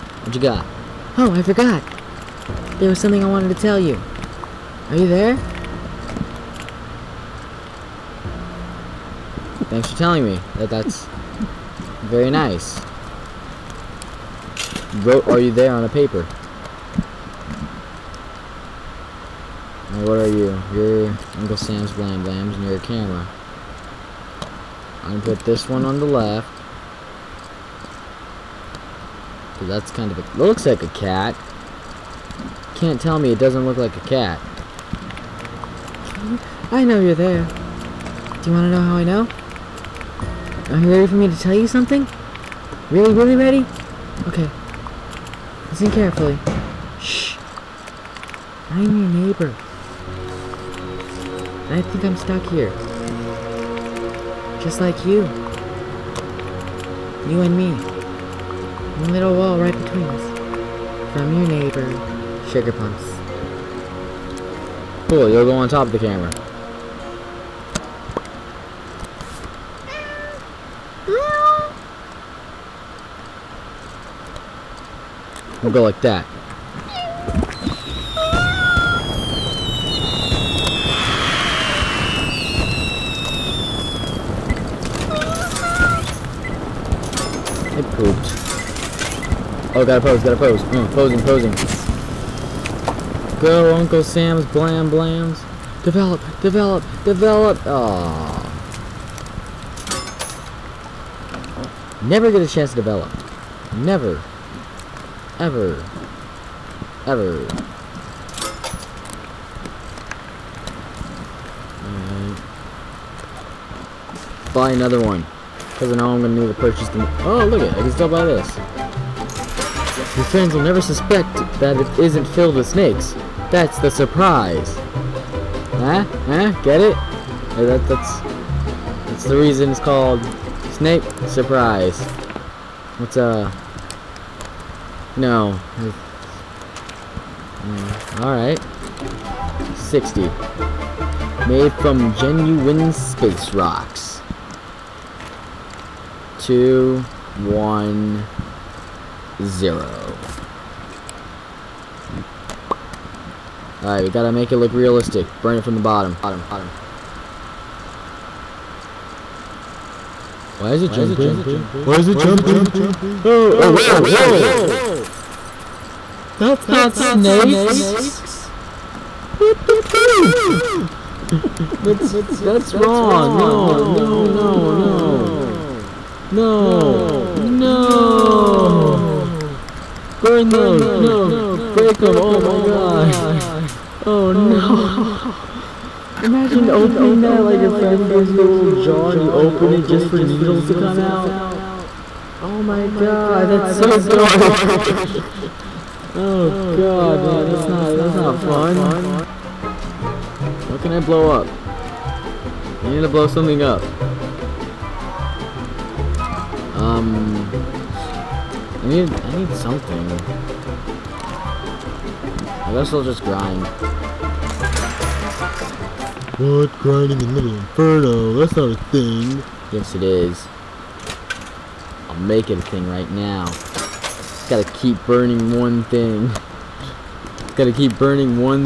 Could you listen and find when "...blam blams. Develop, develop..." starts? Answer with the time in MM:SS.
01:34.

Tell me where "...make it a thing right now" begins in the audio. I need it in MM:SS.
03:42.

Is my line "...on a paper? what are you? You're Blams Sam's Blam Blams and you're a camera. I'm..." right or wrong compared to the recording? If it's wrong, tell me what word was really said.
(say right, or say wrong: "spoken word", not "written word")
wrong: "Uncle", not "Blams".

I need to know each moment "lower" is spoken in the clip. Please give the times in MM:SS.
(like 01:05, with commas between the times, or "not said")
not said.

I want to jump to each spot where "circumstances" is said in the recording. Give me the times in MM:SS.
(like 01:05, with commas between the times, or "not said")
not said.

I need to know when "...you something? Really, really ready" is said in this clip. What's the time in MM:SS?
00:41.